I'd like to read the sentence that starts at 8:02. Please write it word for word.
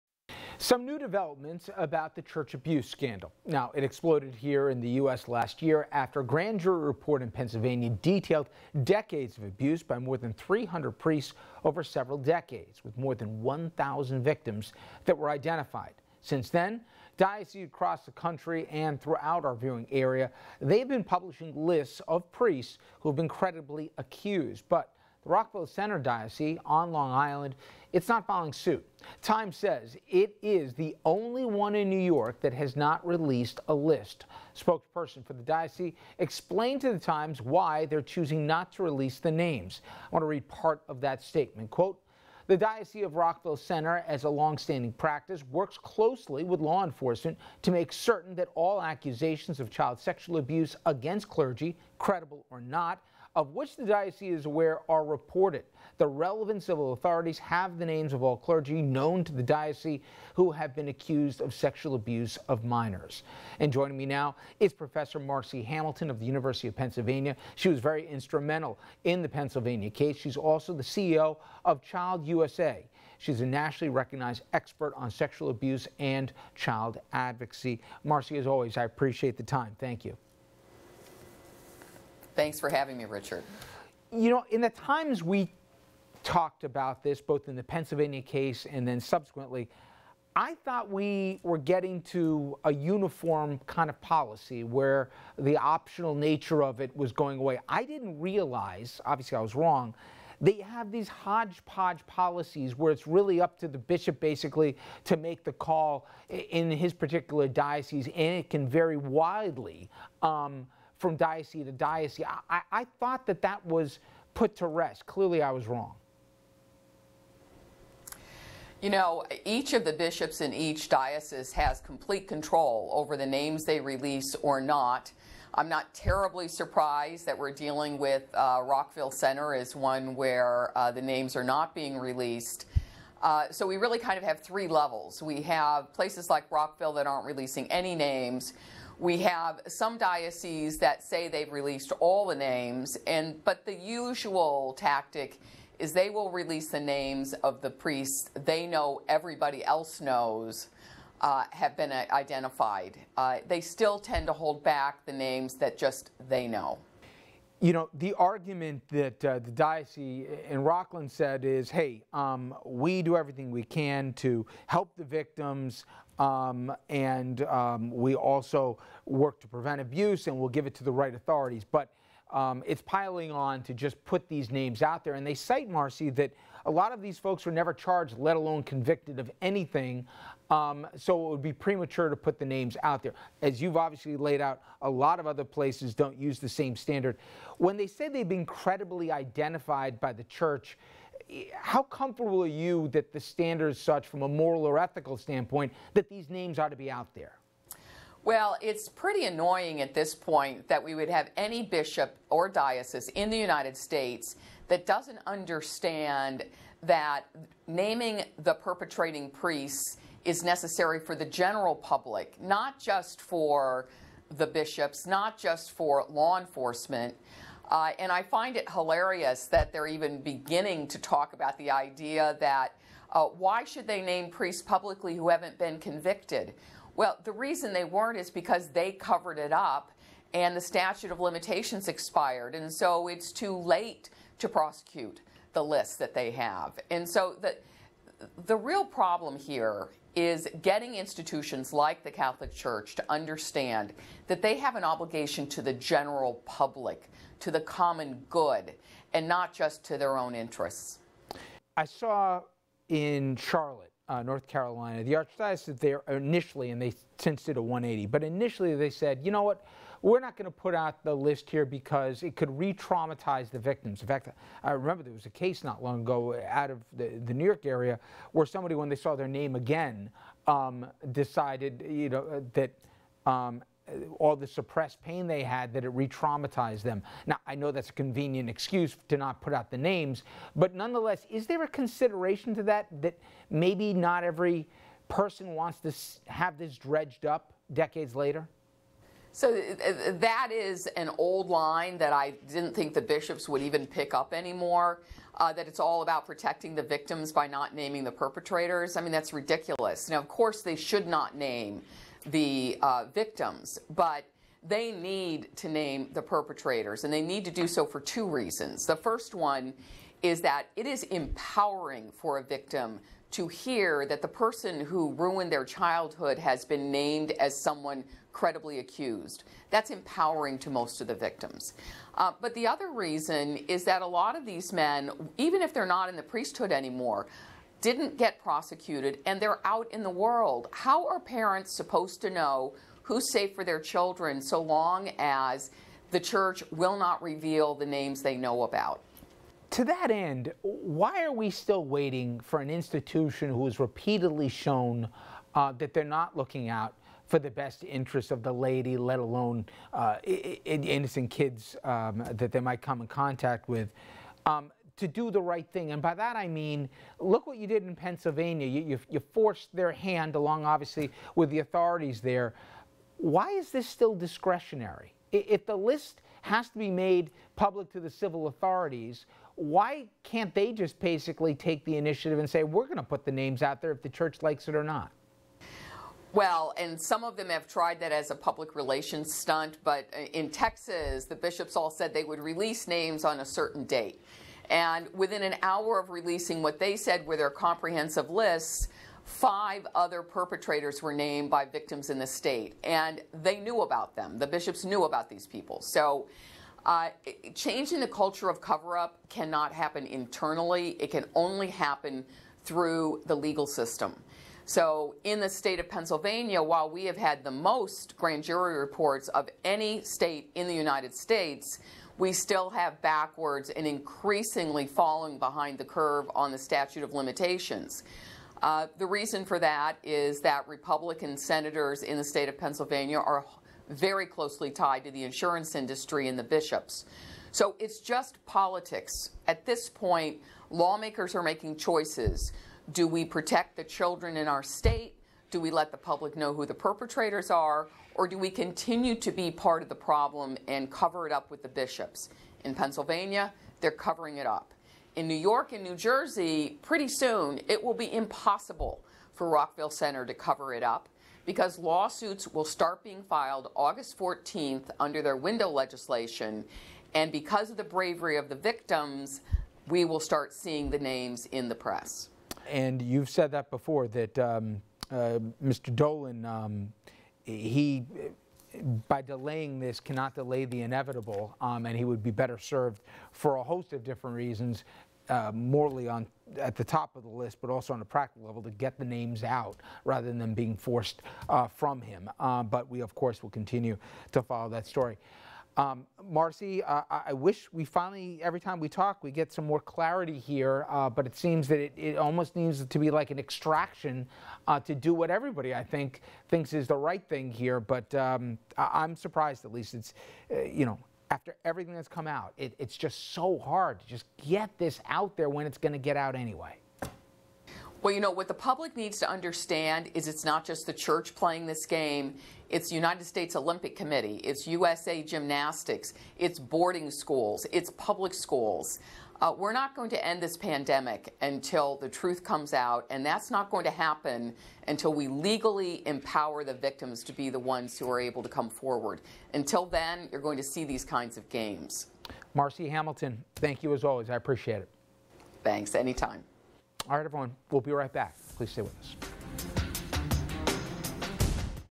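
Uh, but we, of course, will continue to follow that story.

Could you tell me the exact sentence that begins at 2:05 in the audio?
I'm not terribly surprised that we're dealing with uh, Rockville Centre as one where uh, the names are not being released.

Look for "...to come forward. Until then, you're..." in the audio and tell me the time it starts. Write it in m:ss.
8:48.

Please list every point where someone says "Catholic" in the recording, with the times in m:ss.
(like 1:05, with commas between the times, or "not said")
4:02.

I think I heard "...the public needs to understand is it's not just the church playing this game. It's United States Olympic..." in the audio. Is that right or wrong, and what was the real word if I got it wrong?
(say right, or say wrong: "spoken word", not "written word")
right.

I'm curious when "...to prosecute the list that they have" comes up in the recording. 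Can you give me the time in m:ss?
3:54.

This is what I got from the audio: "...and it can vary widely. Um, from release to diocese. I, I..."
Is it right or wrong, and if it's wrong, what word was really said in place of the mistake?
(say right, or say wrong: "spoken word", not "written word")
wrong: "diocese", not "release".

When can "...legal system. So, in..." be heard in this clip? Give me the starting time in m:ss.
6:43.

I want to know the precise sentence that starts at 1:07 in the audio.
She was very instrumental in the Pennsylvania case.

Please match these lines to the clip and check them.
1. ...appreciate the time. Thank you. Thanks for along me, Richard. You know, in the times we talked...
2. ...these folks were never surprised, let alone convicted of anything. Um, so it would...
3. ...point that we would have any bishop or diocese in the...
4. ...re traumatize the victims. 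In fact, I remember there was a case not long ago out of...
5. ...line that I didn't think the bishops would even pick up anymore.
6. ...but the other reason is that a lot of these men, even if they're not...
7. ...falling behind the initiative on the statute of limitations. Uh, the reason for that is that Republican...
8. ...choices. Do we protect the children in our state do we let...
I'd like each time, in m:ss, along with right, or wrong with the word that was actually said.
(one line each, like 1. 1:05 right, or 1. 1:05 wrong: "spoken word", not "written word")
1. 1:18 wrong: "having", not "along"
2. 2:57 wrong: "charged", not "surprised"
3. 3:20 right
4. 4:22 right
5. 4:51 right
6. 5:22 right
7. 6:54 wrong: "curve", not "initiative"
8. 7:11 right.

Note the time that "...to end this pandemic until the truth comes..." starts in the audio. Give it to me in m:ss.
8:40.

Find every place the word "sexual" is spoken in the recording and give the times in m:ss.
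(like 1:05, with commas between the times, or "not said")
0:49, 1:01, 1:15.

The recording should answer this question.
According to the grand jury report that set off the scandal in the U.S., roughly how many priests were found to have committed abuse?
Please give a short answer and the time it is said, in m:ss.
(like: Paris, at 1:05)
more than 300, at 0:09.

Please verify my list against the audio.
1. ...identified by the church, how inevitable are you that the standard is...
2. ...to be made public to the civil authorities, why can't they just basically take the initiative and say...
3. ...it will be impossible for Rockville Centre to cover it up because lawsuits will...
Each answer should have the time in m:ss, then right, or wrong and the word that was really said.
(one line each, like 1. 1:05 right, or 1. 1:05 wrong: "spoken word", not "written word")
1. 3:09 wrong: "comfortable", not "inevitable"
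2. 6:06 right
3. 7:27 right.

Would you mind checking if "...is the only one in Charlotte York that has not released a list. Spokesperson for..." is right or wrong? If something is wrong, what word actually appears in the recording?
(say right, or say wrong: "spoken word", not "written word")
wrong: "New", not "Charlotte".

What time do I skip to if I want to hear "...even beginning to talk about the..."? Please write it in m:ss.
3:39.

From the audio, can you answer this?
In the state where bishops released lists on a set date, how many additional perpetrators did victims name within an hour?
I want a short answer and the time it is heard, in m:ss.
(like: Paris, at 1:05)
5, at 6:29.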